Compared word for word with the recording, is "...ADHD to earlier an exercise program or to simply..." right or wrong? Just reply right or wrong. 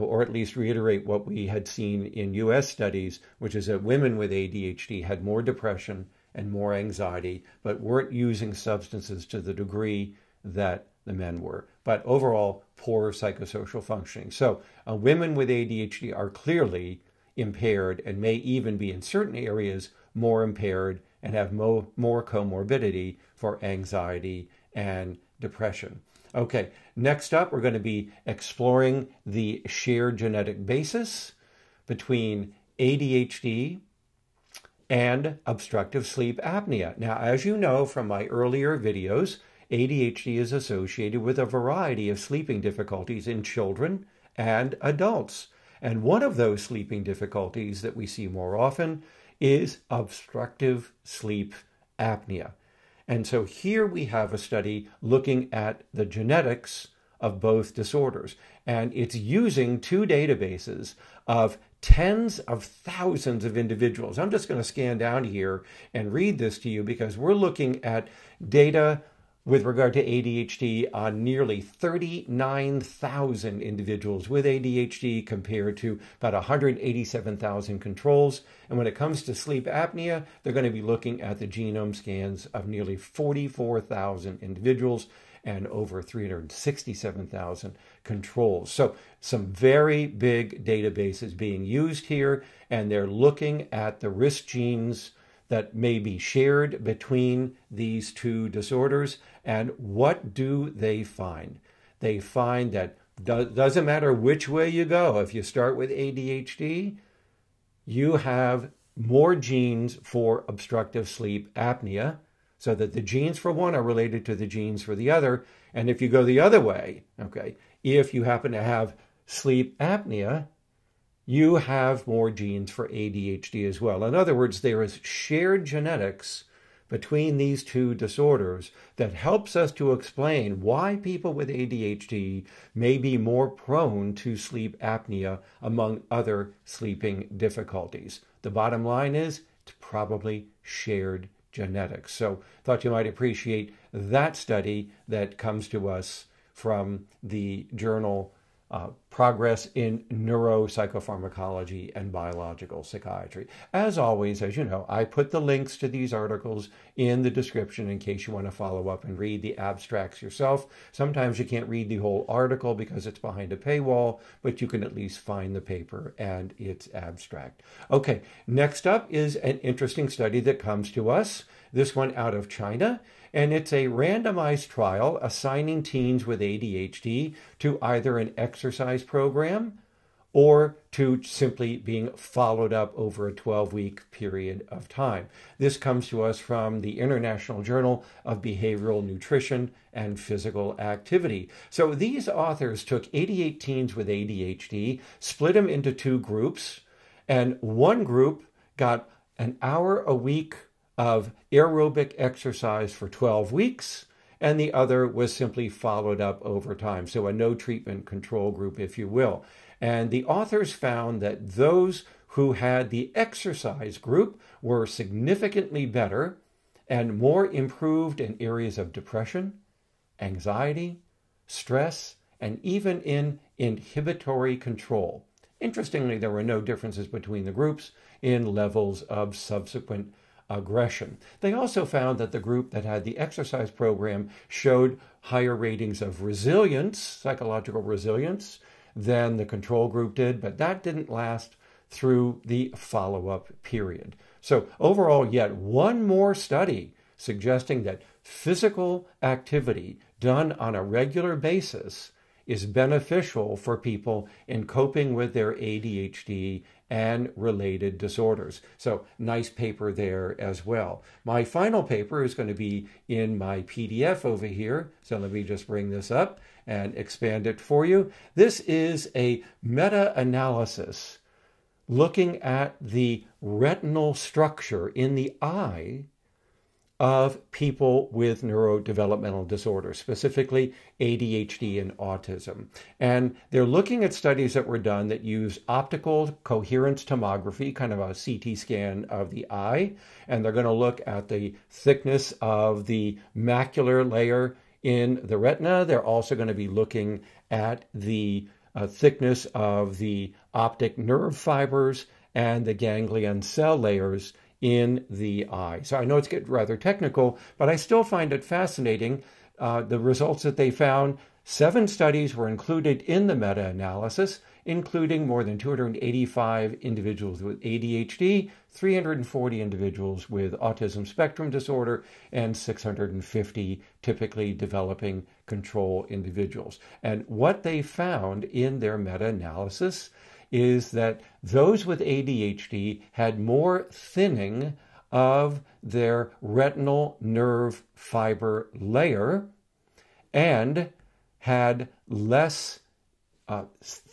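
wrong.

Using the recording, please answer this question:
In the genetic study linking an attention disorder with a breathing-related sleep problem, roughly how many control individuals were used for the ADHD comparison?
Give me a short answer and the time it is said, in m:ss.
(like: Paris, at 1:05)
187,000, at 1:16.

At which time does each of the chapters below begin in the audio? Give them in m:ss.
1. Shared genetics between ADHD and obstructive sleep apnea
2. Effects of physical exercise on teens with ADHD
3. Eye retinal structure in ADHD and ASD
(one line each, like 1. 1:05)
1. 0:26
2. 2:48
3. 4:20.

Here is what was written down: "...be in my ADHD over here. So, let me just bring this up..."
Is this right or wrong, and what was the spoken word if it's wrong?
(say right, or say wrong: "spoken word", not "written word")
wrong: "PDF", not "ADHD".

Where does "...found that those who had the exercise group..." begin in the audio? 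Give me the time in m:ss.
3:30.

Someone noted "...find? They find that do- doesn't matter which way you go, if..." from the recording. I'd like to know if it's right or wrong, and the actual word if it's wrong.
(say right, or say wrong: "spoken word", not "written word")
right.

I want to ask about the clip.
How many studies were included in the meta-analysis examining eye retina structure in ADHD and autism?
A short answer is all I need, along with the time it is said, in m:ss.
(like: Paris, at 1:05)
7, at 5:11.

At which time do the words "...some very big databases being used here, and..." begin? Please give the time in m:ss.
1:29.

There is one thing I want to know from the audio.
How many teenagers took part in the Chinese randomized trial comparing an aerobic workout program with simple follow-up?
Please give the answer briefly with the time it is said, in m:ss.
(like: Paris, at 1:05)
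88, at 3:13.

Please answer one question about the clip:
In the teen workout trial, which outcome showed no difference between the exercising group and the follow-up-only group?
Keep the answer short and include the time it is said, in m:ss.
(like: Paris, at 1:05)
Aggression, at 3:50.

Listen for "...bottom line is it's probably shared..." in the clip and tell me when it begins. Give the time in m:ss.
2:18.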